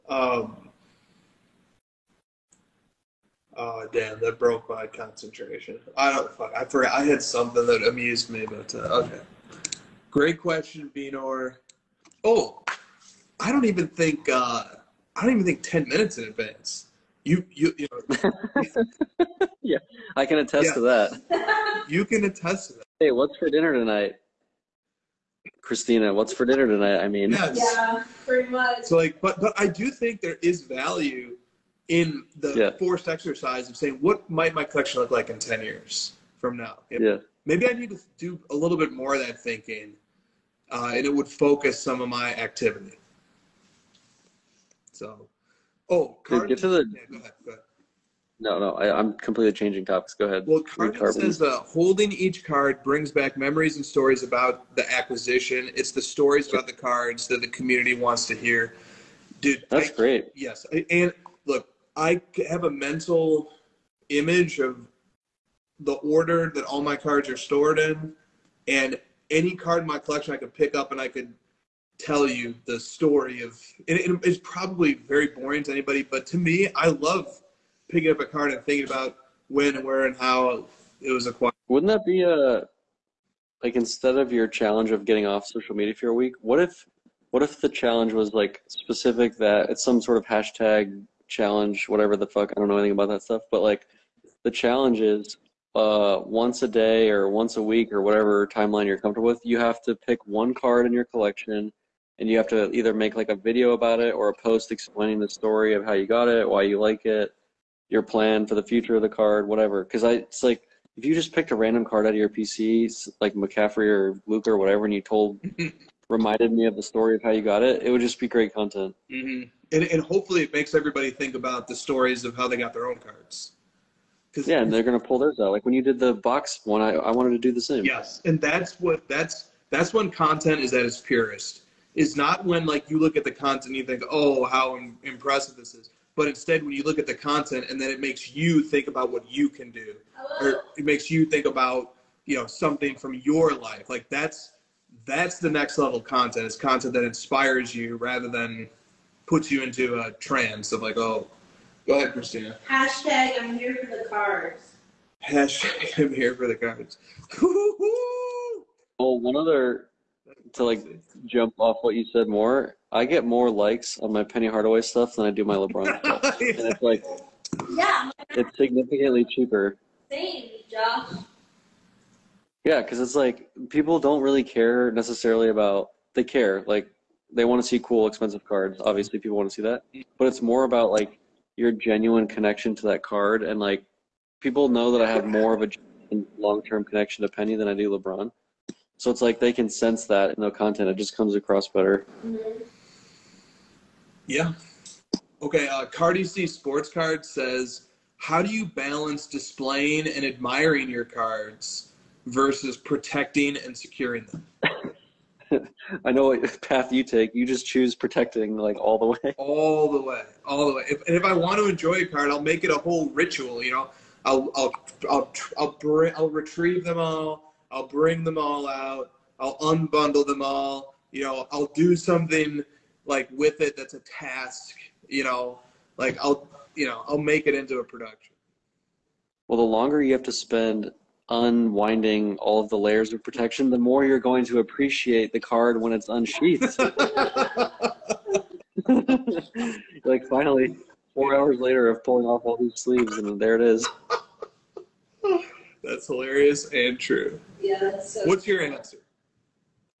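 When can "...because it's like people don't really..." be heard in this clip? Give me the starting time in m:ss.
2:52.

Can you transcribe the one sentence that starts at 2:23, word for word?
Like that's that's the next level content.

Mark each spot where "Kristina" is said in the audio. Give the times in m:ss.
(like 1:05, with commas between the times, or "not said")
0:25, 2:32.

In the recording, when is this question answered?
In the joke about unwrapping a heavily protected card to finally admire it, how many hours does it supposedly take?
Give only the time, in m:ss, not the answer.
4:01.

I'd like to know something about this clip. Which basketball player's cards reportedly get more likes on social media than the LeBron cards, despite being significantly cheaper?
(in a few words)
Penny Hardaway.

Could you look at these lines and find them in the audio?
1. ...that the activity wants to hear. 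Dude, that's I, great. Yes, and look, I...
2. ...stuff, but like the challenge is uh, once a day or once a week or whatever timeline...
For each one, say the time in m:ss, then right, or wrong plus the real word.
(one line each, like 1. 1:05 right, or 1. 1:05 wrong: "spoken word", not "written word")
1. 0:57 wrong: "community", not "activity"
2. 1:33 right.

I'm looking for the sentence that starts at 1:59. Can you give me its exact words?
Mm-hmm and, and hopefully it makes everybody think about the stories of how they got their own cards.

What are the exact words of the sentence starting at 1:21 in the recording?
Wouldn't that be a like instead of your challenge of getting off social media for a week?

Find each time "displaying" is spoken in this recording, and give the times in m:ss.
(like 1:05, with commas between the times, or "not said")
3:19.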